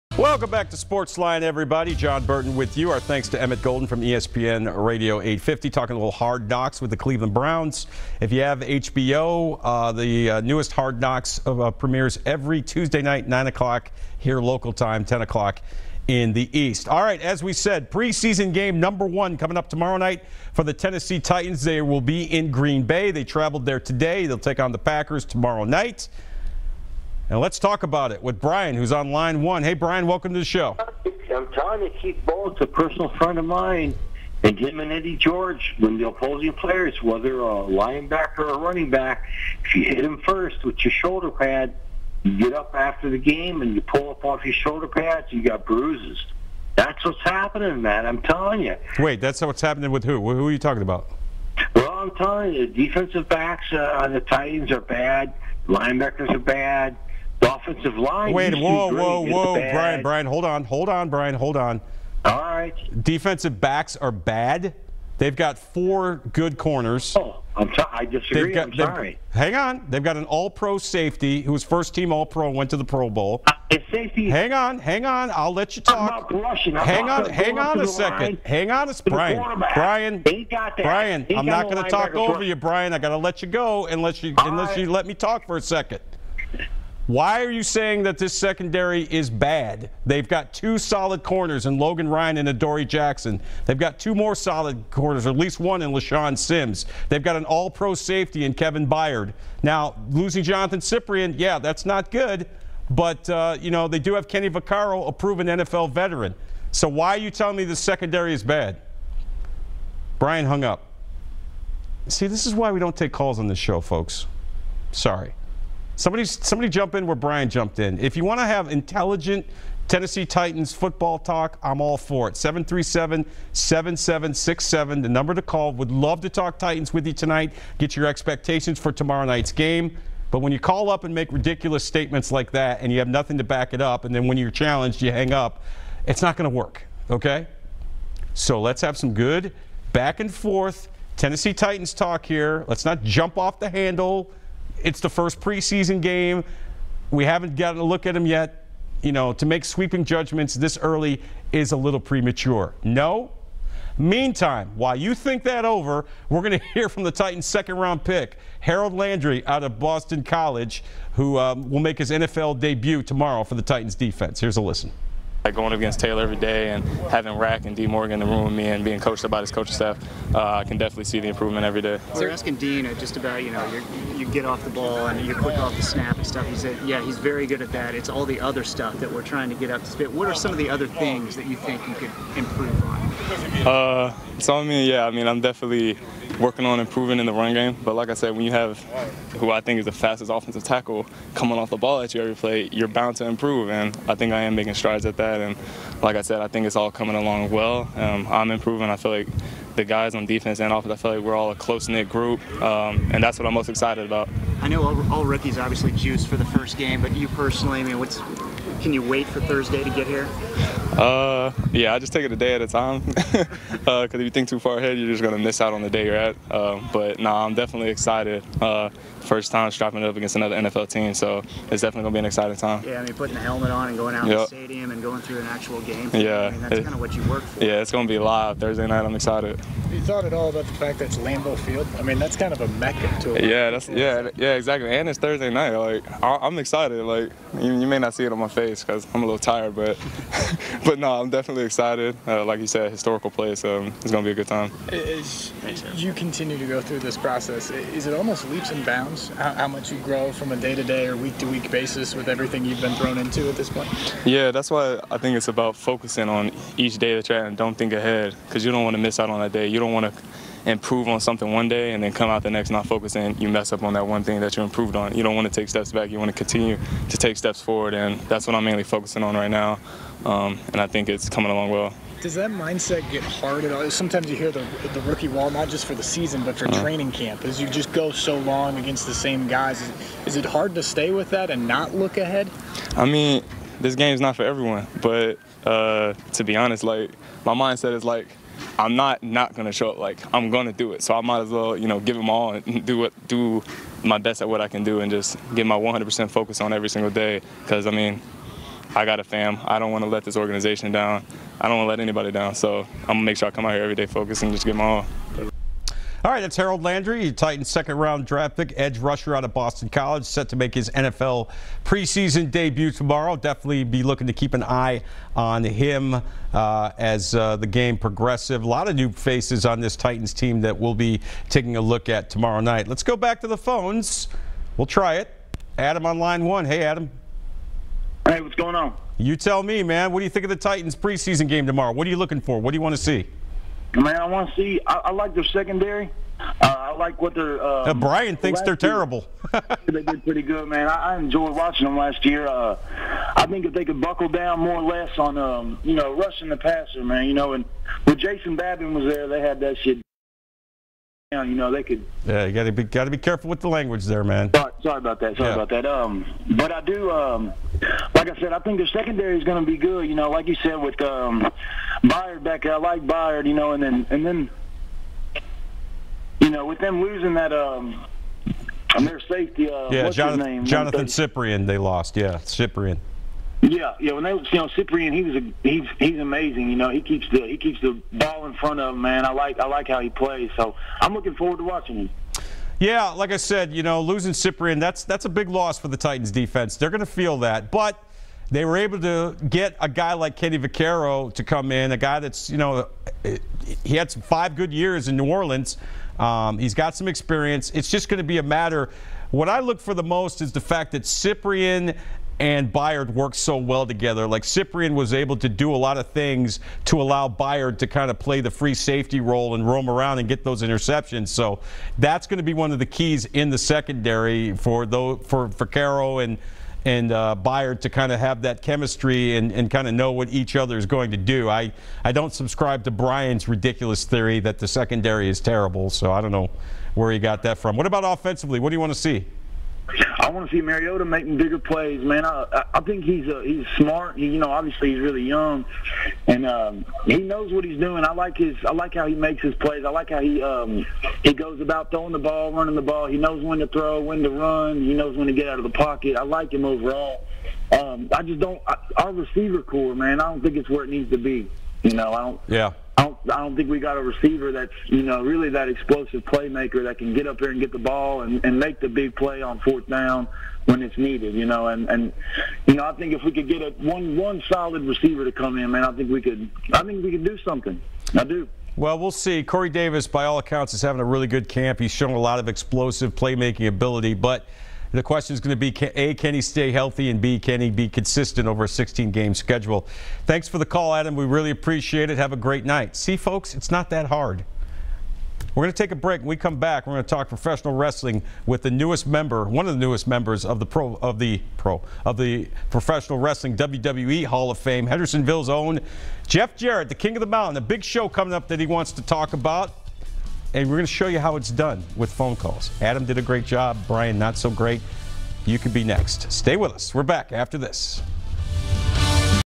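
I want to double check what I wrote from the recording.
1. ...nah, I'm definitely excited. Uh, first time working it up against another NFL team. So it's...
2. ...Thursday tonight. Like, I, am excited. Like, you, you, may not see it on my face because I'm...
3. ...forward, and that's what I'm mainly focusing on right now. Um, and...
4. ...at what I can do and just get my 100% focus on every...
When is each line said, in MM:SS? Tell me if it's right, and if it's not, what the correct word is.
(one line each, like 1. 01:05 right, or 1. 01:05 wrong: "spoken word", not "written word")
1. 03:37 wrong: "strapping", not "working"
2. 03:55 wrong: "night", not "tonight"
3. 04:27 right
4. 04:54 right.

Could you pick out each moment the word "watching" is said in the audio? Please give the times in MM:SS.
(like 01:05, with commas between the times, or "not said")
05:41, 06:21.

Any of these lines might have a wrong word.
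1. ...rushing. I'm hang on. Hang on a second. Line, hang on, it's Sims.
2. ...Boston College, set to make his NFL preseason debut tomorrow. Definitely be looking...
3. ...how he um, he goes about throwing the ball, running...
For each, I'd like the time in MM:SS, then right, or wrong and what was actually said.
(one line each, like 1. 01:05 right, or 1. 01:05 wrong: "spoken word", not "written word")
1. 01:16 wrong: "Brian", not "Sims"
2. 05:09 right
3. 07:20 right.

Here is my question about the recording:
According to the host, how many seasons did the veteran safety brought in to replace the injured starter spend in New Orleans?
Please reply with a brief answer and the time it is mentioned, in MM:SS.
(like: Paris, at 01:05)
5, at 06:34.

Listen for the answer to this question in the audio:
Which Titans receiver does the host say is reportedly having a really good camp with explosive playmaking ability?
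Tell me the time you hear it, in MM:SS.
07:49.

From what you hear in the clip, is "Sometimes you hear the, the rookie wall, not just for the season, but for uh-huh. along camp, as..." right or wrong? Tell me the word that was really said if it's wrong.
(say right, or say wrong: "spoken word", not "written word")
wrong: "training", not "along".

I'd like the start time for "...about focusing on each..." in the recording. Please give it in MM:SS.
04:15.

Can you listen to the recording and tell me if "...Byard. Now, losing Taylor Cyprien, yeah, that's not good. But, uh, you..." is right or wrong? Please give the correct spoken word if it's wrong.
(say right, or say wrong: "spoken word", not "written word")
wrong: "Johnathan", not "Taylor".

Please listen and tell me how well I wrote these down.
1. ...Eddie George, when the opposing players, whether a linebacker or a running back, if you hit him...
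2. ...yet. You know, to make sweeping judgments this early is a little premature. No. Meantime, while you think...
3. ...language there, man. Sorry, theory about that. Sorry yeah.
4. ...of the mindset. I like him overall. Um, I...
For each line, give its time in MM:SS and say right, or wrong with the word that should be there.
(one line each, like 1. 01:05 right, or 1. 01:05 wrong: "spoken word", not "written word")
1. 00:34 right
2. 02:28 right
3. 05:53 wrong: "sorry", not "theory"
4. 07:25 wrong: "pocket", not "mindset".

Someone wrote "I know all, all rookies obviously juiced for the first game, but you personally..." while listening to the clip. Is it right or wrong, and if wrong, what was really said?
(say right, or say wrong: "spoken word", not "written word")
right.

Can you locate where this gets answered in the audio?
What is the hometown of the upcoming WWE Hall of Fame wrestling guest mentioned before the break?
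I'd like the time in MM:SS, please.
08:14.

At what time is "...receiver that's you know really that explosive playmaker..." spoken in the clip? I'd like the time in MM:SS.
07:34.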